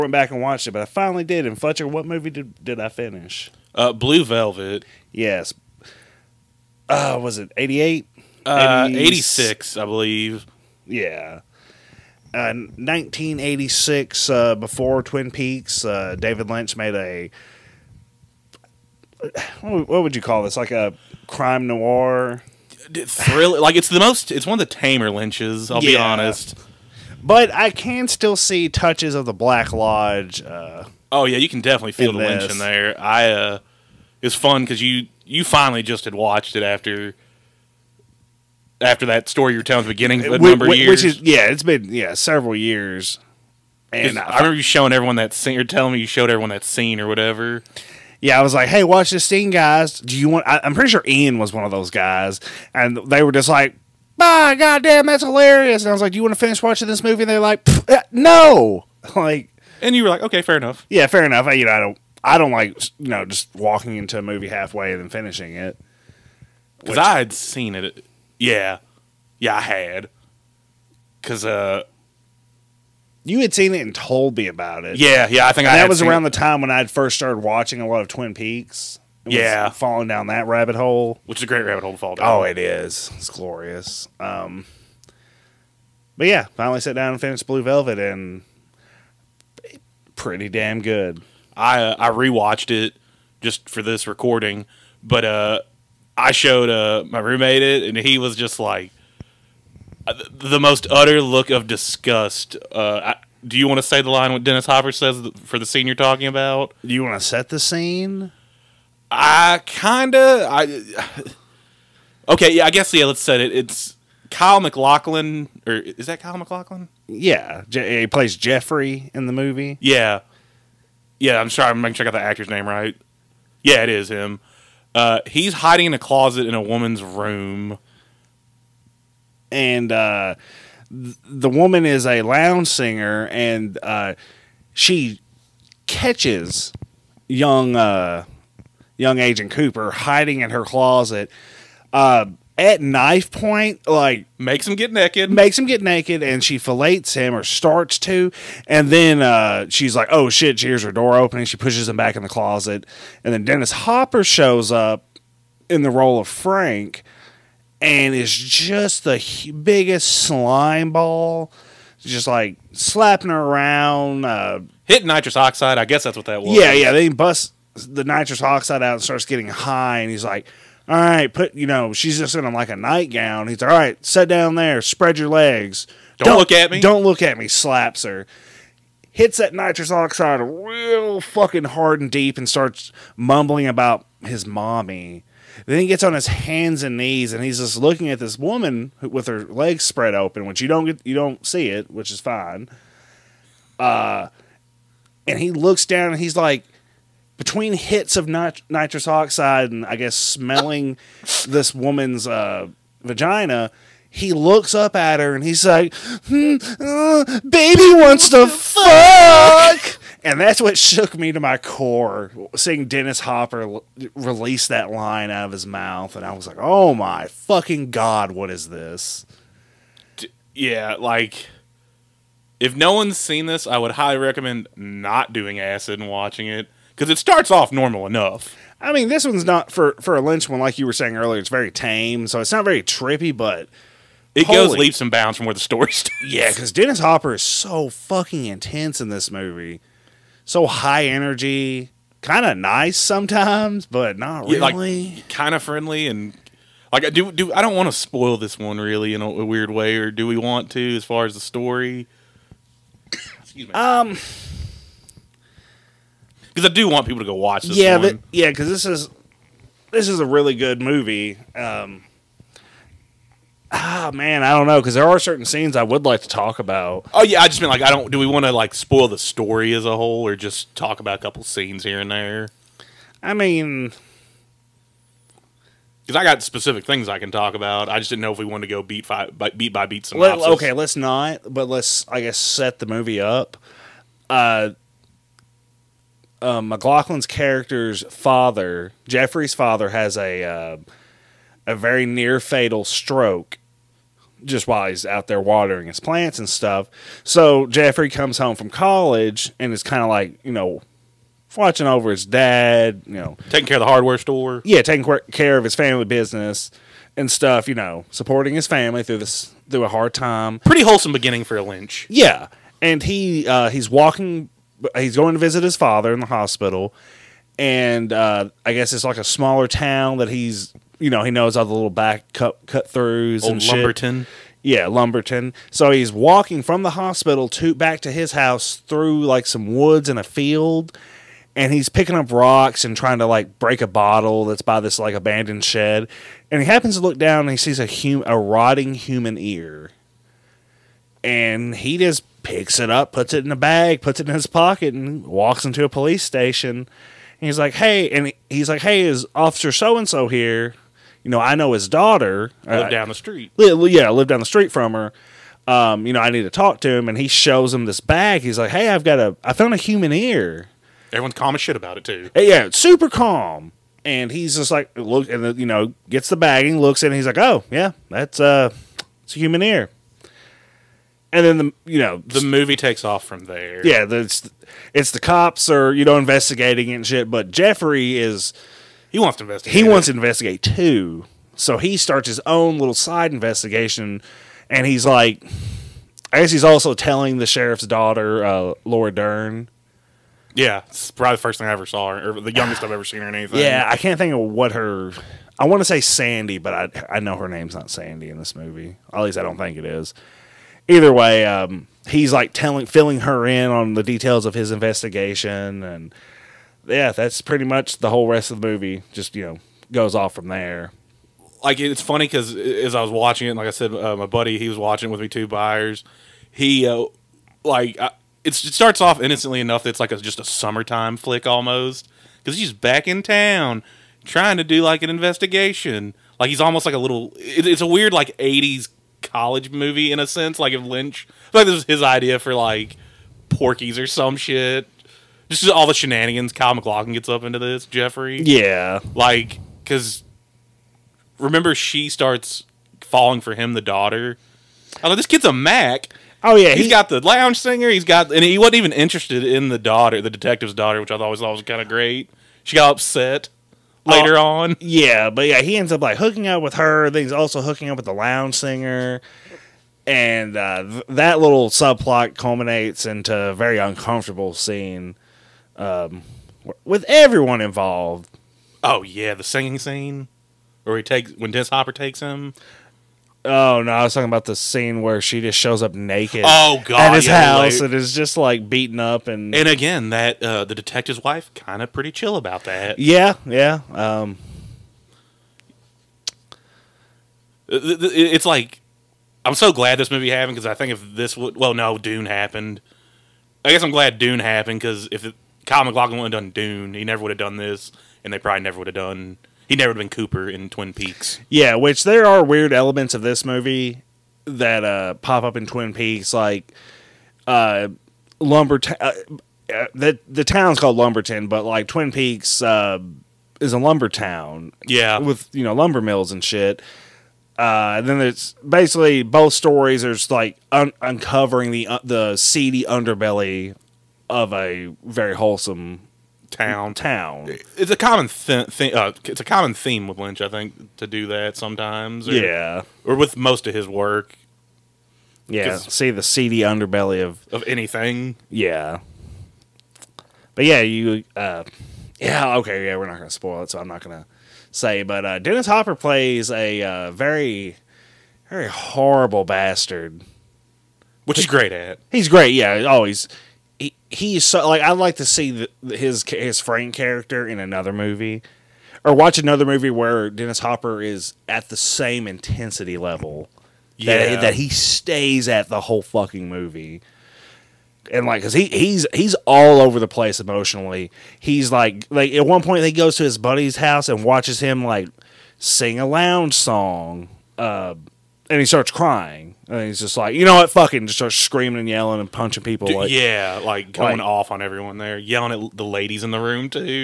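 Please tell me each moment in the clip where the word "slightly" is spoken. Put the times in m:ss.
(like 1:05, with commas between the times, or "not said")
not said.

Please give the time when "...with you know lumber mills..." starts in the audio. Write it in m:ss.
8:35.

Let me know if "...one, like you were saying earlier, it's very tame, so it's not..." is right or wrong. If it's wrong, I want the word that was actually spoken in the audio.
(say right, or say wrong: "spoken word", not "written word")
right.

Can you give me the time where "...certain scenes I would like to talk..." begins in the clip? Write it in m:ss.
4:25.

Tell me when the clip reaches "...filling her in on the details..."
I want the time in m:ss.
6:42.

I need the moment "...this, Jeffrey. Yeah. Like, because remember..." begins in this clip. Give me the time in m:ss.
7:17.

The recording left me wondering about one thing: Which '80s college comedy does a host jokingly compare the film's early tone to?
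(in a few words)
Porky's.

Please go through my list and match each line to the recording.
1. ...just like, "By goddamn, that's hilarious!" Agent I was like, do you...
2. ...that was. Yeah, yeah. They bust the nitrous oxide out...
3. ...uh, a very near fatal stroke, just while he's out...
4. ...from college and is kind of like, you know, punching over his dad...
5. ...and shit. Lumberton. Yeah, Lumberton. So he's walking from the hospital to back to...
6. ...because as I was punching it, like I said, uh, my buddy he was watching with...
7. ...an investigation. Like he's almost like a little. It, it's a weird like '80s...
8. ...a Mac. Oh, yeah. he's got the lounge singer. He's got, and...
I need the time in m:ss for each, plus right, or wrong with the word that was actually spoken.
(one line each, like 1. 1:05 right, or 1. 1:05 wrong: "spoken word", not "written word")
1. 0:53 wrong: "And", not "Agent"
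2. 2:46 right
3. 4:50 right
4. 4:58 wrong: "watching", not "punching"
5. 5:23 right
6. 6:52 wrong: "watching", not "punching"
7. 7:05 right
8. 7:25 right.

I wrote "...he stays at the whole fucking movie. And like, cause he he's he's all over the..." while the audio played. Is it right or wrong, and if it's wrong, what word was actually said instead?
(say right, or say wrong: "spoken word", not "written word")
right.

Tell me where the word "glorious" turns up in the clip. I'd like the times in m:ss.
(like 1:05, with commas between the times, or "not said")
1:23.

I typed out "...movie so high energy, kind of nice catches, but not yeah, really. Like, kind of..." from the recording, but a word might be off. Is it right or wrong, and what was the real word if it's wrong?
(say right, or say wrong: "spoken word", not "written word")
wrong: "sometimes", not "catches".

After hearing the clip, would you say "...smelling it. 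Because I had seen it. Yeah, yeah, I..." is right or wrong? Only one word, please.
wrong.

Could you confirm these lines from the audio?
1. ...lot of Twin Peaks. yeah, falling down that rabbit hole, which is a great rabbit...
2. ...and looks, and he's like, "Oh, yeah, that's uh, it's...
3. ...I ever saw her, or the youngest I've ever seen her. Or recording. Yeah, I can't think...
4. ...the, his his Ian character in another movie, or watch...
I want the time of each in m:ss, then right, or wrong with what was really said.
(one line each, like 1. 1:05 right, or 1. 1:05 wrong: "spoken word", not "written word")
1. 1:17 right
2. 6:06 right
3. 6:31 wrong: "anything", not "recording"
4. 9:15 wrong: "Frank", not "Ian".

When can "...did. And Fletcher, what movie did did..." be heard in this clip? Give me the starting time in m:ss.
0:01.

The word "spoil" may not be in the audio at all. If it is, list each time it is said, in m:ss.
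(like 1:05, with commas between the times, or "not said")
4:07, 4:28, 9:03.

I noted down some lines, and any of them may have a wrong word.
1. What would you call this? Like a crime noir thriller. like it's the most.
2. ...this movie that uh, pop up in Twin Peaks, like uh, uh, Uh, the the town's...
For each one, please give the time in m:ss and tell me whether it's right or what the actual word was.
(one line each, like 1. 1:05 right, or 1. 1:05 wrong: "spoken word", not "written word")
1. 0:19 right
2. 8:23 right.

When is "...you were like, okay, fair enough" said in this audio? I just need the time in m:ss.
0:59.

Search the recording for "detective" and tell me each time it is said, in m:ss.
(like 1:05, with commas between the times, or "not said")
7:30, 8:00.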